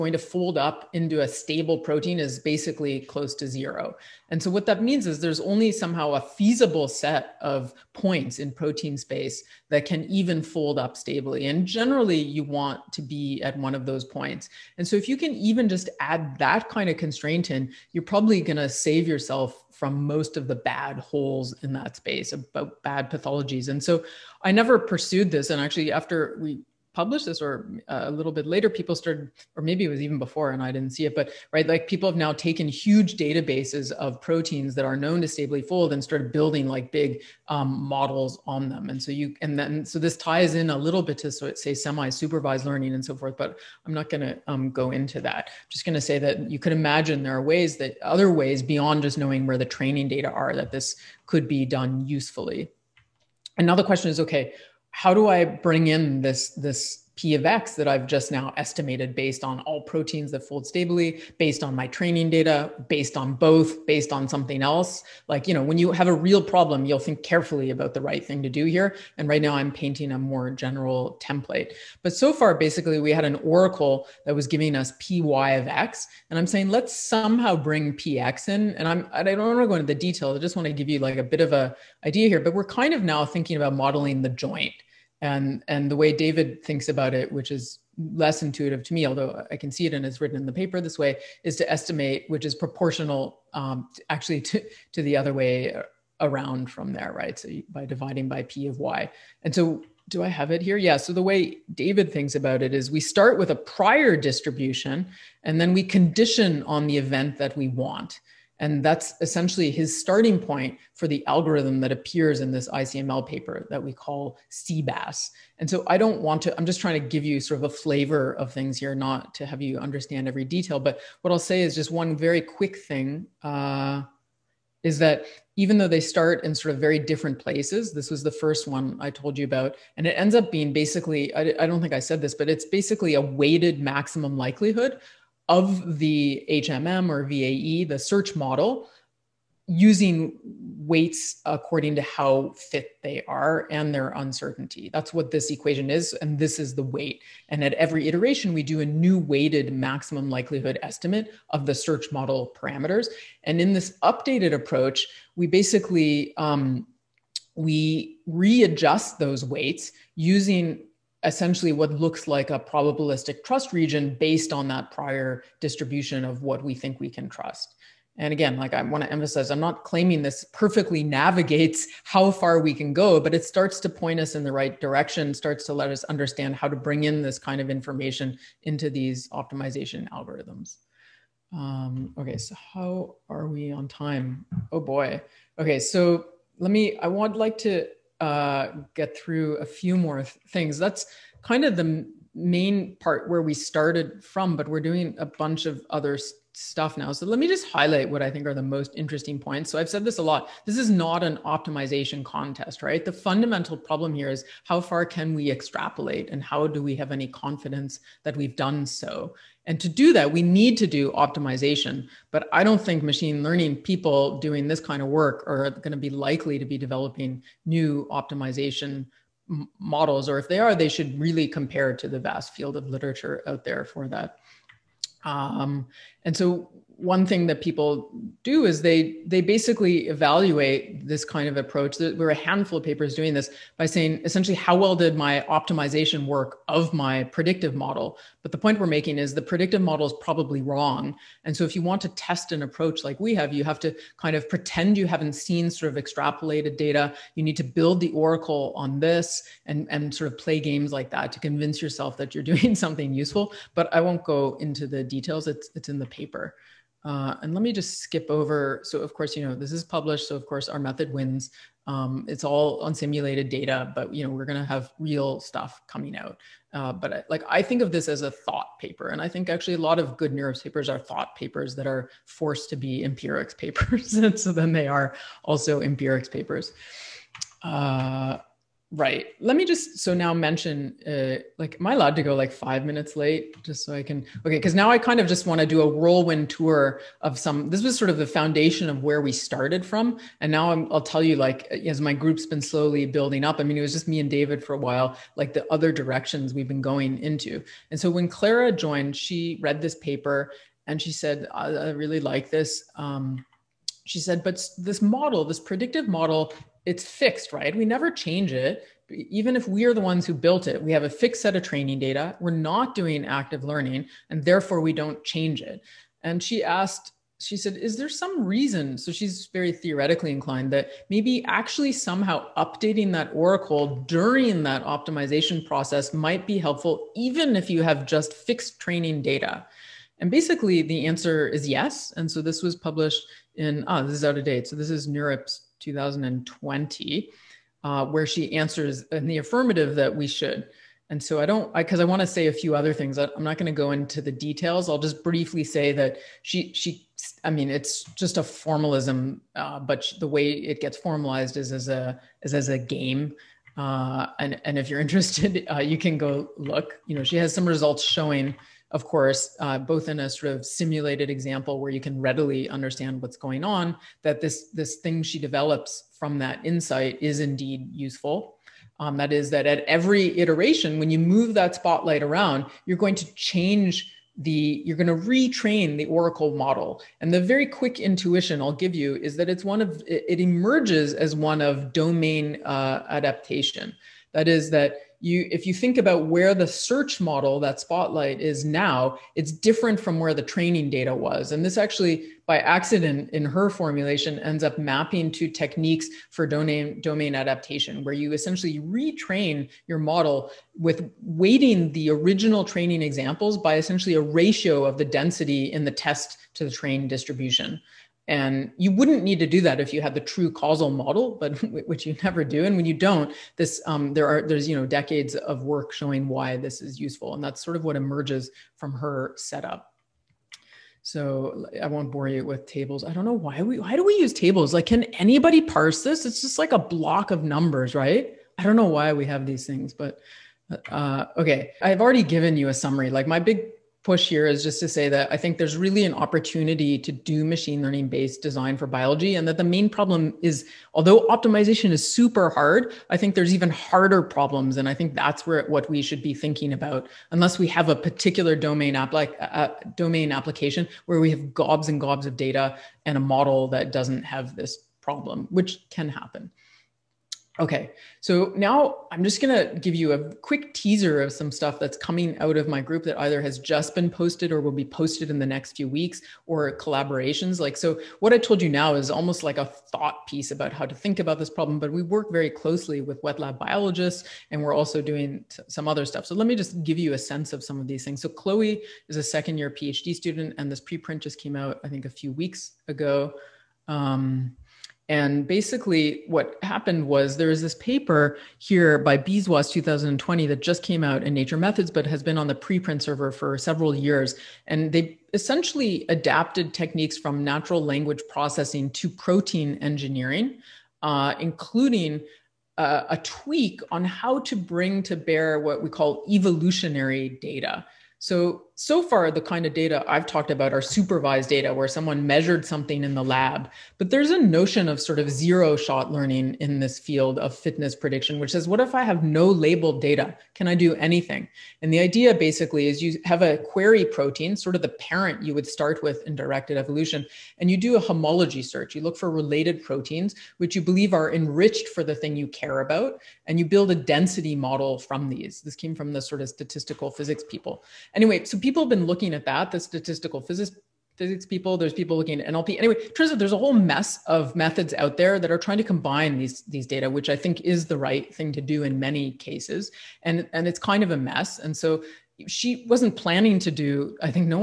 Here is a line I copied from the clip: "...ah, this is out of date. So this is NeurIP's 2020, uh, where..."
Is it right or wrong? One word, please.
right.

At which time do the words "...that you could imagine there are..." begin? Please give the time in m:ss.
0:46.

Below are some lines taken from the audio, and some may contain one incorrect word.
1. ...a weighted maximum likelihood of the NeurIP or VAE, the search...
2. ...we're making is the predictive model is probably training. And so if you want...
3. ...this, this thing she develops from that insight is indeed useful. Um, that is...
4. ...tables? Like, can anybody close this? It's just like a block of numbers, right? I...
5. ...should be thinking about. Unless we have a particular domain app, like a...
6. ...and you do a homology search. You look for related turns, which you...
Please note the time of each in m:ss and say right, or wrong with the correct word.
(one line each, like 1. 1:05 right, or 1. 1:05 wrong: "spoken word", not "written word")
1. 2:13 wrong: "HMM", not "NeurIP"
2. 3:58 wrong: "wrong", not "training"
3. 6:04 right
4. 7:04 wrong: "parse", not "close"
5. 7:26 right
6. 8:47 wrong: "proteins", not "turns".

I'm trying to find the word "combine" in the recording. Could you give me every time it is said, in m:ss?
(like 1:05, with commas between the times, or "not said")
9:05.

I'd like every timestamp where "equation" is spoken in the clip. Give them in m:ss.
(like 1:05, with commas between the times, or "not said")
2:25.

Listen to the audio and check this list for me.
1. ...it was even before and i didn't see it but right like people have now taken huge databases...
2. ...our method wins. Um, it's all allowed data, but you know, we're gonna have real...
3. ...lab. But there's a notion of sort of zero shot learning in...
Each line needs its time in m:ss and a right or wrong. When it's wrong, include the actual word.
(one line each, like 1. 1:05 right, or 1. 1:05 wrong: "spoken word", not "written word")
1. 0:29 right
2. 4:20 wrong: "unsimulated", not "allowed"
3. 8:33 right.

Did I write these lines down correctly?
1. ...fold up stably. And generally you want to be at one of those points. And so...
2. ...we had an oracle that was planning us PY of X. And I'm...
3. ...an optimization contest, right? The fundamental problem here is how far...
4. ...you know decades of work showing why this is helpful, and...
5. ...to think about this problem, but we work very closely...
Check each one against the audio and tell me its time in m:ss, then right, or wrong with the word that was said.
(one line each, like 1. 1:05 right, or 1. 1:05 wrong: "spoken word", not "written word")
1. 0:10 right
2. 1:12 wrong: "giving", not "planning"
3. 3:21 right
4. 6:54 wrong: "useful", not "helpful"
5. 7:50 right.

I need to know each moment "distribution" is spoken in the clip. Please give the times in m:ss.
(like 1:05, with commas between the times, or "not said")
1:44, 2:45, 6:47.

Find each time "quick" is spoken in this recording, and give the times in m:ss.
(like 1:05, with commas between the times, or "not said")
2:02, 6:17, 7:40.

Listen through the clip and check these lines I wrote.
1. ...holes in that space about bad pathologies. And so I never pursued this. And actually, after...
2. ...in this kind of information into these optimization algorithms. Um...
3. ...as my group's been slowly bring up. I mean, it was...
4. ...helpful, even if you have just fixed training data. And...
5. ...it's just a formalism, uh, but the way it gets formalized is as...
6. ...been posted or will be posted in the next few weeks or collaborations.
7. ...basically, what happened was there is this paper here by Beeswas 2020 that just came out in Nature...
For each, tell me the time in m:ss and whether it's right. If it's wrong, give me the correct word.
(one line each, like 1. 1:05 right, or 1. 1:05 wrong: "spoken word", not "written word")
1. 0:20 right
2. 2:57 right
3. 4:51 wrong: "building", not "bring"
4. 5:26 right
5. 5:47 right
6. 7:43 right
7. 8:05 right.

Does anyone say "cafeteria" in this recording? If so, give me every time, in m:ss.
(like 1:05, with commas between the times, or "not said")
not said.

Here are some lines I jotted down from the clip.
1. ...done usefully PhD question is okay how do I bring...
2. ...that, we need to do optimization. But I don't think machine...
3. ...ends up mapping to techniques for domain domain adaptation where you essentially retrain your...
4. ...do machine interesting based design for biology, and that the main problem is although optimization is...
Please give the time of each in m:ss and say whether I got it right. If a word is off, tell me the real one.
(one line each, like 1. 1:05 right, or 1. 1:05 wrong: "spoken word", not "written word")
1. 0:51 wrong: "Another", not "PhD"
2. 3:30 right
3. 6:34 right
4. 7:17 wrong: "learning", not "interesting".